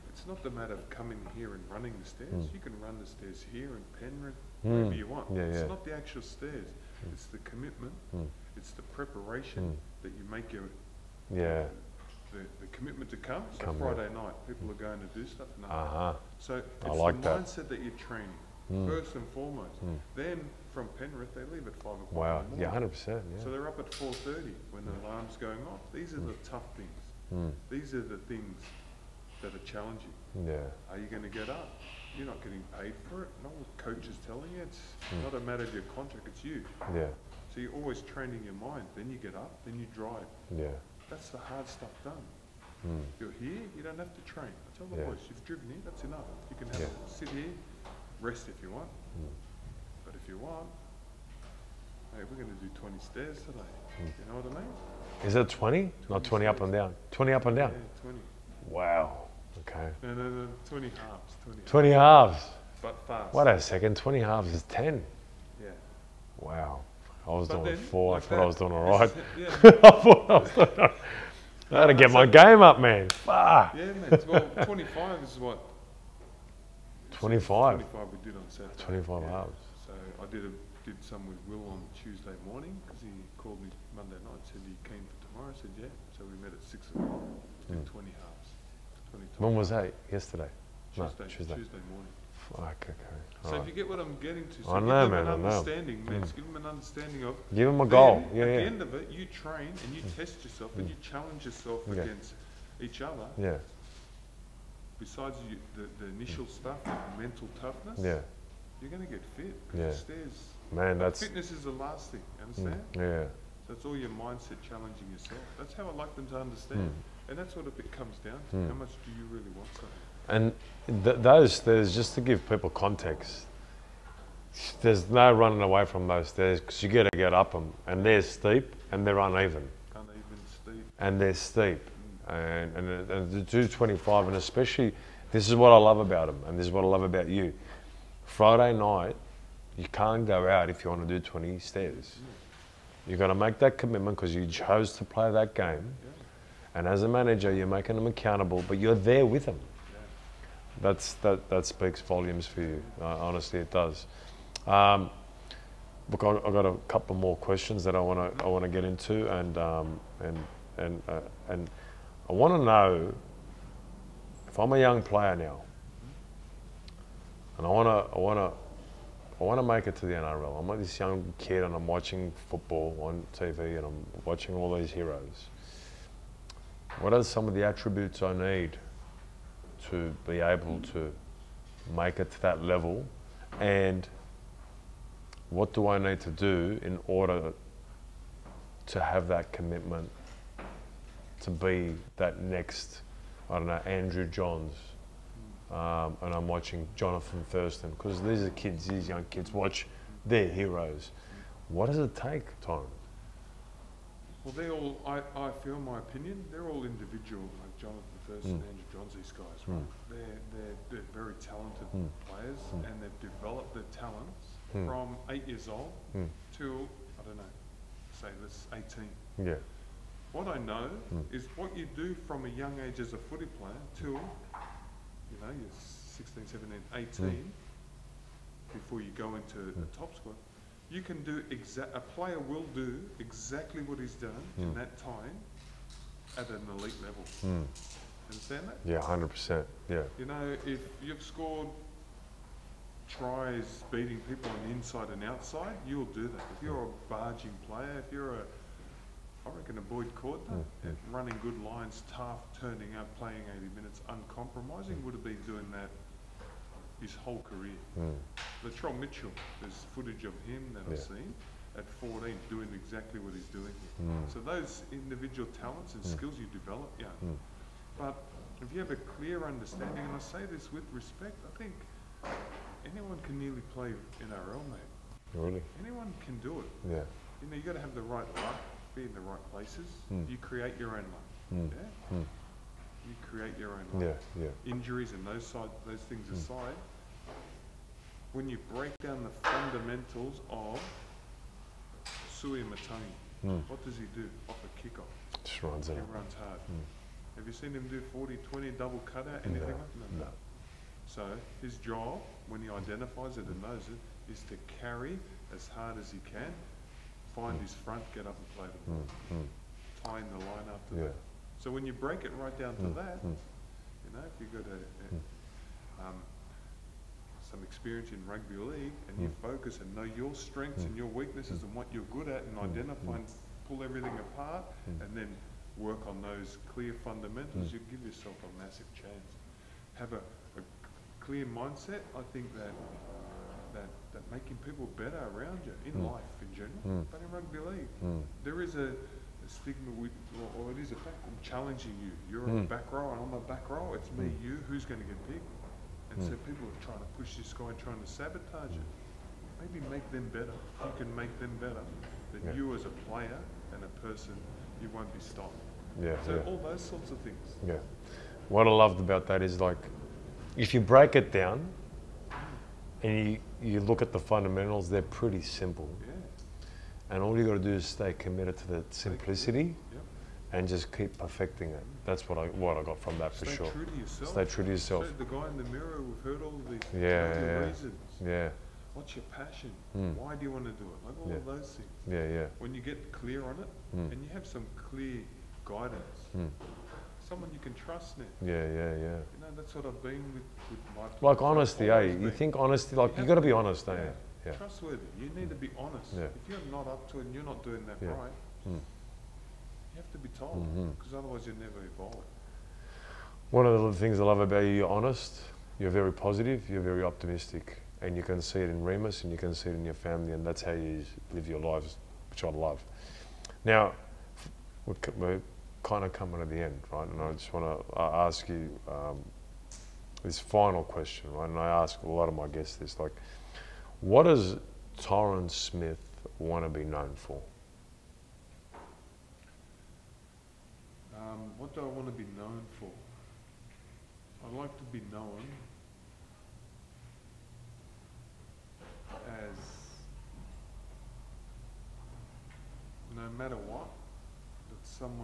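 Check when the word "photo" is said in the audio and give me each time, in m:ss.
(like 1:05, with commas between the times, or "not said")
not said.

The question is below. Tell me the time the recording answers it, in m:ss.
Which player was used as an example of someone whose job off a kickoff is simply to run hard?
4:52.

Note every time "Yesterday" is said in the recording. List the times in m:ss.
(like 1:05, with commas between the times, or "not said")
1:30.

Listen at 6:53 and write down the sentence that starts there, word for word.
Now, we're kind of coming to the end, right?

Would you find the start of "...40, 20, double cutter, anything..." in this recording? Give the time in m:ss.
4:58.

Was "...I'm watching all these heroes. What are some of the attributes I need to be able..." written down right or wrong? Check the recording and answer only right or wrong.
right.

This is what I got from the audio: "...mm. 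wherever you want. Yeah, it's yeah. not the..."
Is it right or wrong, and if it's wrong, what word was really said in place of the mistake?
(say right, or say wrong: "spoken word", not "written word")
right.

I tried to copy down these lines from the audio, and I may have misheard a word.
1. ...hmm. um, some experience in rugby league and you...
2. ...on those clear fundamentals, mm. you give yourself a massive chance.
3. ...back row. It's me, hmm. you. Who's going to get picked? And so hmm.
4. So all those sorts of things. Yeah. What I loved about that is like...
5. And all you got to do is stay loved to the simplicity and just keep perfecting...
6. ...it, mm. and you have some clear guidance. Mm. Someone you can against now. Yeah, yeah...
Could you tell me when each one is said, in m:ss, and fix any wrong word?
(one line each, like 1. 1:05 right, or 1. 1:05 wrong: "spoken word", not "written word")
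1. 5:15 right
2. 5:26 right
3. 5:43 right
4. 5:56 right
5. 6:07 wrong: "committed", not "loved"
6. 6:23 wrong: "trust", not "against".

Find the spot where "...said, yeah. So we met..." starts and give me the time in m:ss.
1:25.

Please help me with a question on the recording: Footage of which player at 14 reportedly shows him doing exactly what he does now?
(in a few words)
Latrell Mitchell.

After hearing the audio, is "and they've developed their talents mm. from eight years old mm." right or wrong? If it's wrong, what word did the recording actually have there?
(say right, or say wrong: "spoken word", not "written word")
right.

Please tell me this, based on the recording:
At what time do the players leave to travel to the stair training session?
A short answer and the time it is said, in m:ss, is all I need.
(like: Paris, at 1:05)
5 o'clock, at 0:21.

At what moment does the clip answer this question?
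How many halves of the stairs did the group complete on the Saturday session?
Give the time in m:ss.
1:17.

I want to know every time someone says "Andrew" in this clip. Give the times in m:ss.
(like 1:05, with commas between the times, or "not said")
3:13, 3:28.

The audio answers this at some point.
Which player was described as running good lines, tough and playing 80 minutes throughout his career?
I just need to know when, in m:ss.
4:09.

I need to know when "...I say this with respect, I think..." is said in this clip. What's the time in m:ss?
4:30.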